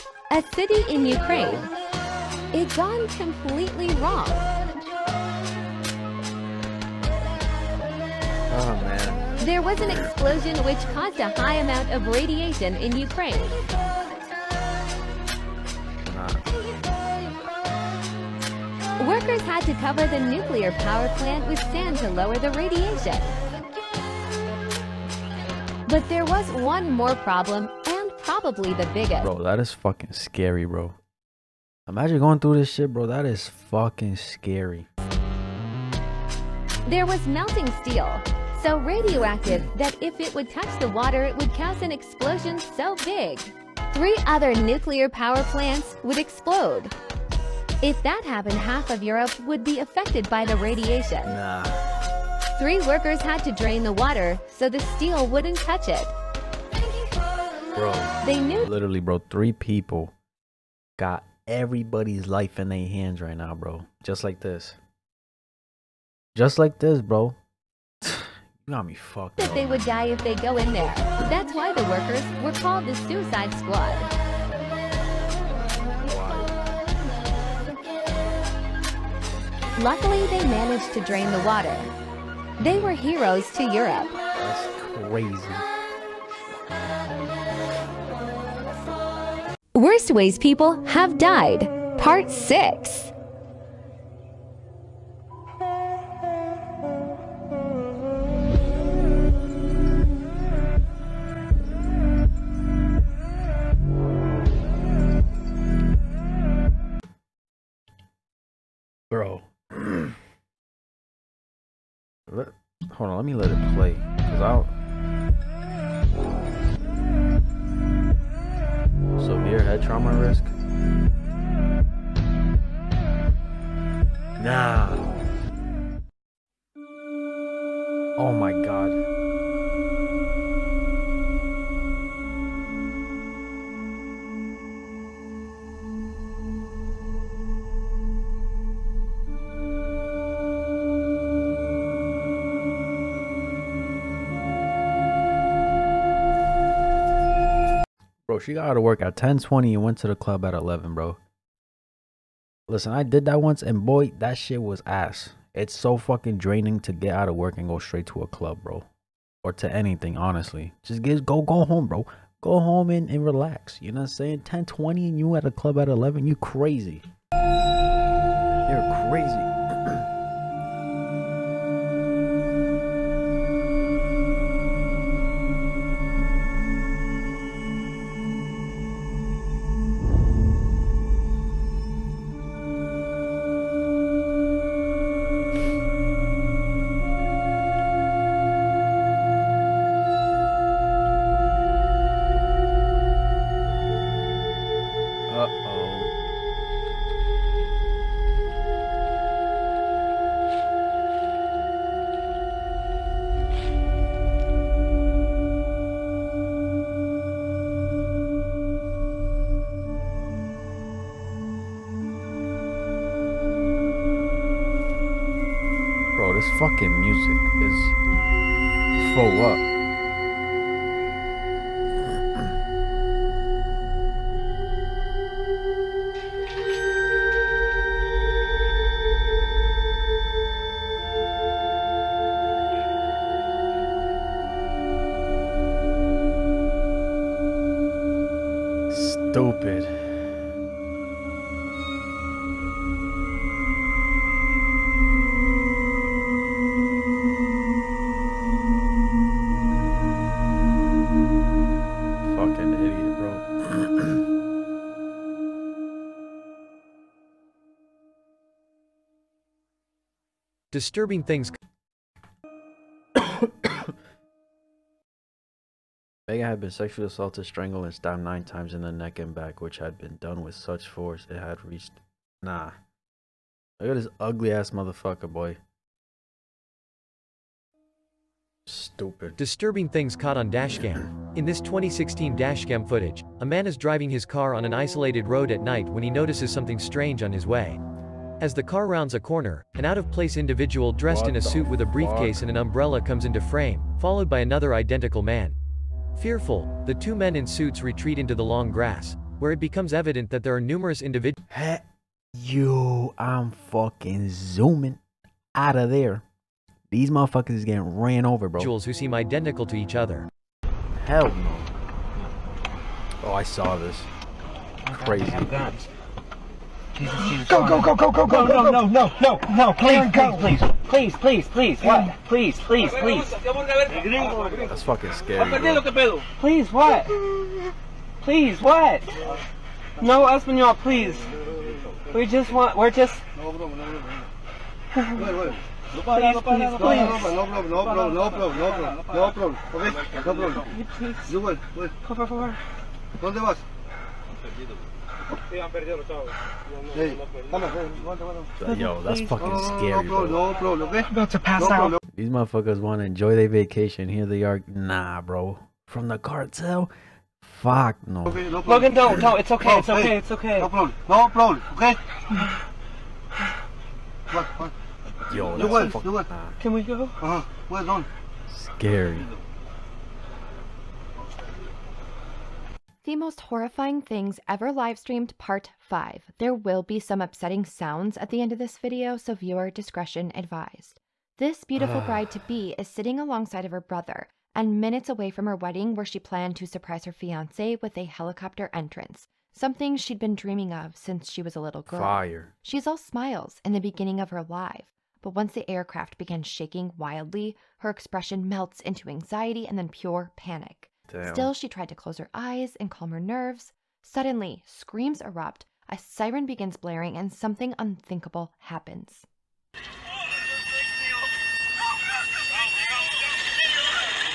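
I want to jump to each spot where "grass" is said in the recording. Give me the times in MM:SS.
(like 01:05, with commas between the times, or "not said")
04:58.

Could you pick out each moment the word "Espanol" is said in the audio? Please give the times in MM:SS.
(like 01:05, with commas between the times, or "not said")
05:30.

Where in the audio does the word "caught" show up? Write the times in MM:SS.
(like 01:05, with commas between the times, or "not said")
04:40.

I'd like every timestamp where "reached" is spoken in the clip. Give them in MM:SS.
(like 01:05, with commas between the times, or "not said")
04:31.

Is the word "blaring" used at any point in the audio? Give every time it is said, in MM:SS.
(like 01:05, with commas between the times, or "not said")
06:46.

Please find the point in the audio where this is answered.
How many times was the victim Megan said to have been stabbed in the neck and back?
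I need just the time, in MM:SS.
04:28.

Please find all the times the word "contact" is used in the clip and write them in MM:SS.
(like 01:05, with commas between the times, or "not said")
not said.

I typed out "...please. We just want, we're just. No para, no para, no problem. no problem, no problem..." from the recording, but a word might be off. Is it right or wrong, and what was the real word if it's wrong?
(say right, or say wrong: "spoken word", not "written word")
right.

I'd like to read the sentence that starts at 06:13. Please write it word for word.
The most horrifying things ever live streamed part 5.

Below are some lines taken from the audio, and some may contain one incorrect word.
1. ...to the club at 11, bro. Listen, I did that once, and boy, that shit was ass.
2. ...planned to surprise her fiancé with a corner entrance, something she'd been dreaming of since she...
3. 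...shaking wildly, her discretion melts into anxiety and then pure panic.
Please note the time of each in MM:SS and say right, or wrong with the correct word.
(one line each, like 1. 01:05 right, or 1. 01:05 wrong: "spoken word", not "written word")
1. 02:29 right
2. 06:26 wrong: "helicopter", not "corner"
3. 06:36 wrong: "expression", not "discretion".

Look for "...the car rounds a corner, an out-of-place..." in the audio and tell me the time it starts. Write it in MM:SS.
04:48.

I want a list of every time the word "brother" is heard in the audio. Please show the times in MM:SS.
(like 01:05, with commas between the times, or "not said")
06:23.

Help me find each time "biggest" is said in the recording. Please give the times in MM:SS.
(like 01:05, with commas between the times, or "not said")
00:28.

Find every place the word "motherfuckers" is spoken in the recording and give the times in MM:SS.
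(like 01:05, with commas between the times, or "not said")
04:34, 05:07, 05:52.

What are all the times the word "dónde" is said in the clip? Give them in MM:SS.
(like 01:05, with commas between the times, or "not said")
05:43.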